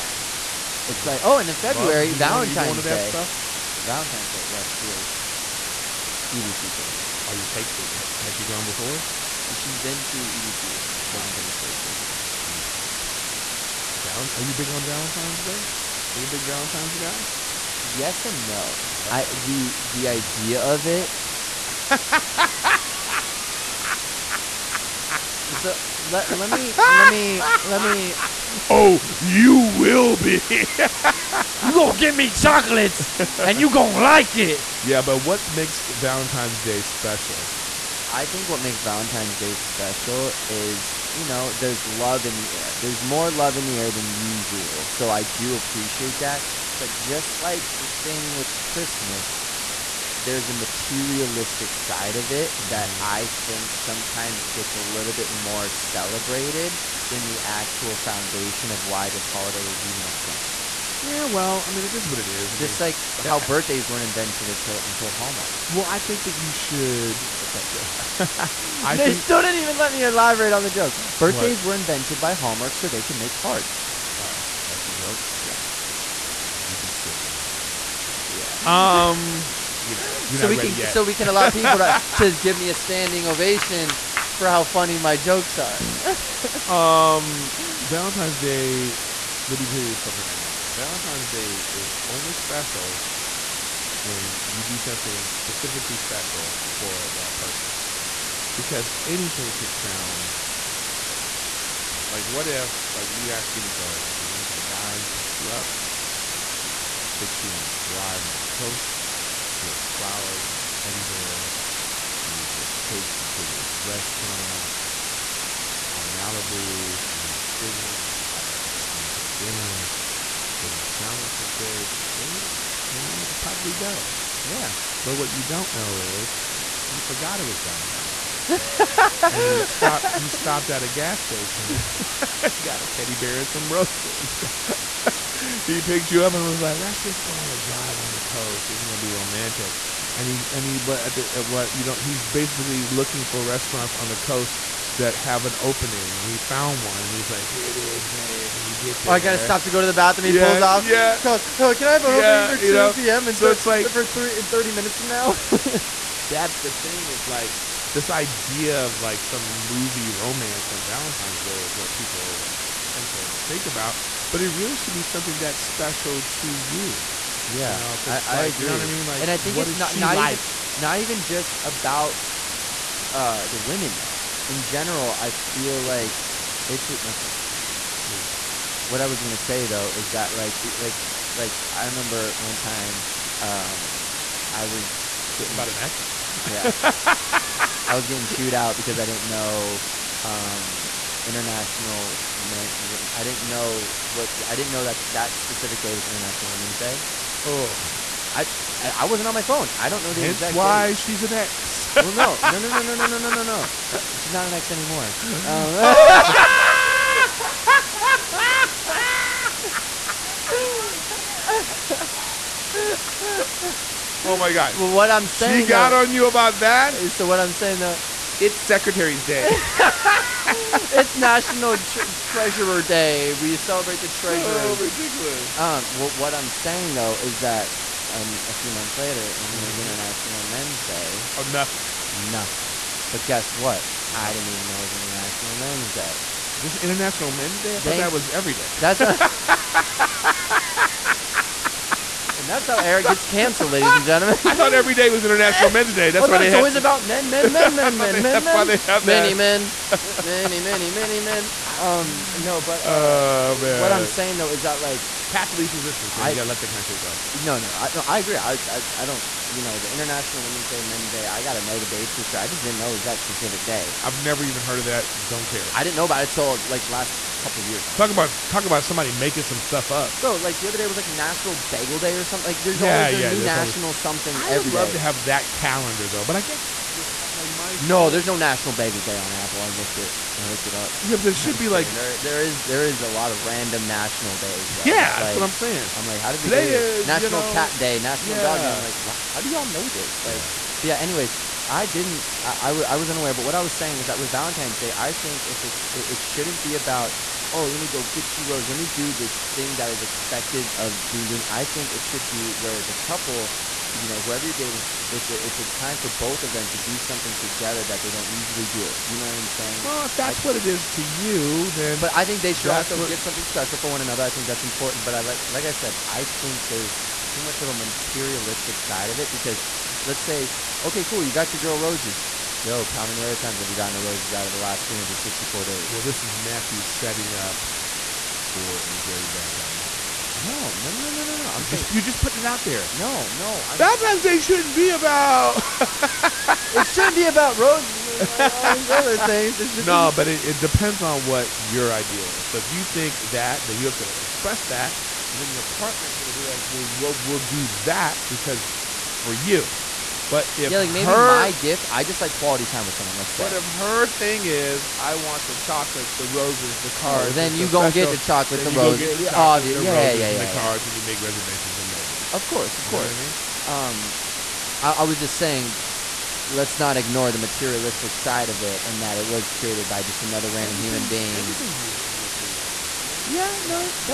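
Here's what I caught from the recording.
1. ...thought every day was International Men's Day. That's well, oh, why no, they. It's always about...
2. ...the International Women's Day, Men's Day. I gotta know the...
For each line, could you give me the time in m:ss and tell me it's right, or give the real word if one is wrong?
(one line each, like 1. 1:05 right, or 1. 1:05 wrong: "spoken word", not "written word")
1. 4:04 right
2. 4:19 right.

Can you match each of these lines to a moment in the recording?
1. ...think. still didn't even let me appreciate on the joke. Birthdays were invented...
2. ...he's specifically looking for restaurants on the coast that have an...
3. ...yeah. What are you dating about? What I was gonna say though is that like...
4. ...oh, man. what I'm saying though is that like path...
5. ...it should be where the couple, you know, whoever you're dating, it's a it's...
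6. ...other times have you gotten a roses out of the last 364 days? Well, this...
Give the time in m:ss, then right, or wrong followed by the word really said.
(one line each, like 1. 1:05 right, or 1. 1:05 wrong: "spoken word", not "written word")
1. 1:09 wrong: "elaborate", not "appreciate"
2. 2:21 wrong: "basically", not "specifically"
3. 2:57 wrong: "talking", not "dating"
4. 4:12 right
5. 5:01 right
6. 5:23 right.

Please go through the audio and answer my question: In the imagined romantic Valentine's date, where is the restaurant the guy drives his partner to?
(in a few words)
Malibu.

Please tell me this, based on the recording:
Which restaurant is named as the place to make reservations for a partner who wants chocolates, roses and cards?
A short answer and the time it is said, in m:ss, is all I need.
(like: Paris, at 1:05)
Nobu, at 6:01.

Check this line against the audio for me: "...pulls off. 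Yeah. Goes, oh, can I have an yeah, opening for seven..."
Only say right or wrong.
wrong.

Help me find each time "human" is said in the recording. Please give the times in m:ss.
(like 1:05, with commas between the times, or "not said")
6:10.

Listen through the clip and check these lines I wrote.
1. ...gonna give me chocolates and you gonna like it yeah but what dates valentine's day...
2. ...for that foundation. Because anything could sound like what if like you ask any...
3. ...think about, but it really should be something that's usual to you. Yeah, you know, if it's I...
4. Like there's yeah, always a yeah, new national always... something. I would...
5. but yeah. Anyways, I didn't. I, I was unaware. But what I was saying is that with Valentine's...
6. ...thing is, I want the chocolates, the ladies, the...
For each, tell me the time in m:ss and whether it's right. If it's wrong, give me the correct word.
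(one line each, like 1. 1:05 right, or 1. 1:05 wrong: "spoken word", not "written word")
1. 0:31 wrong: "makes", not "dates"
2. 1:36 wrong: "person", not "foundation"
3. 2:43 wrong: "special", not "usual"
4. 4:32 right
5. 4:50 right
6. 5:54 wrong: "roses", not "ladies".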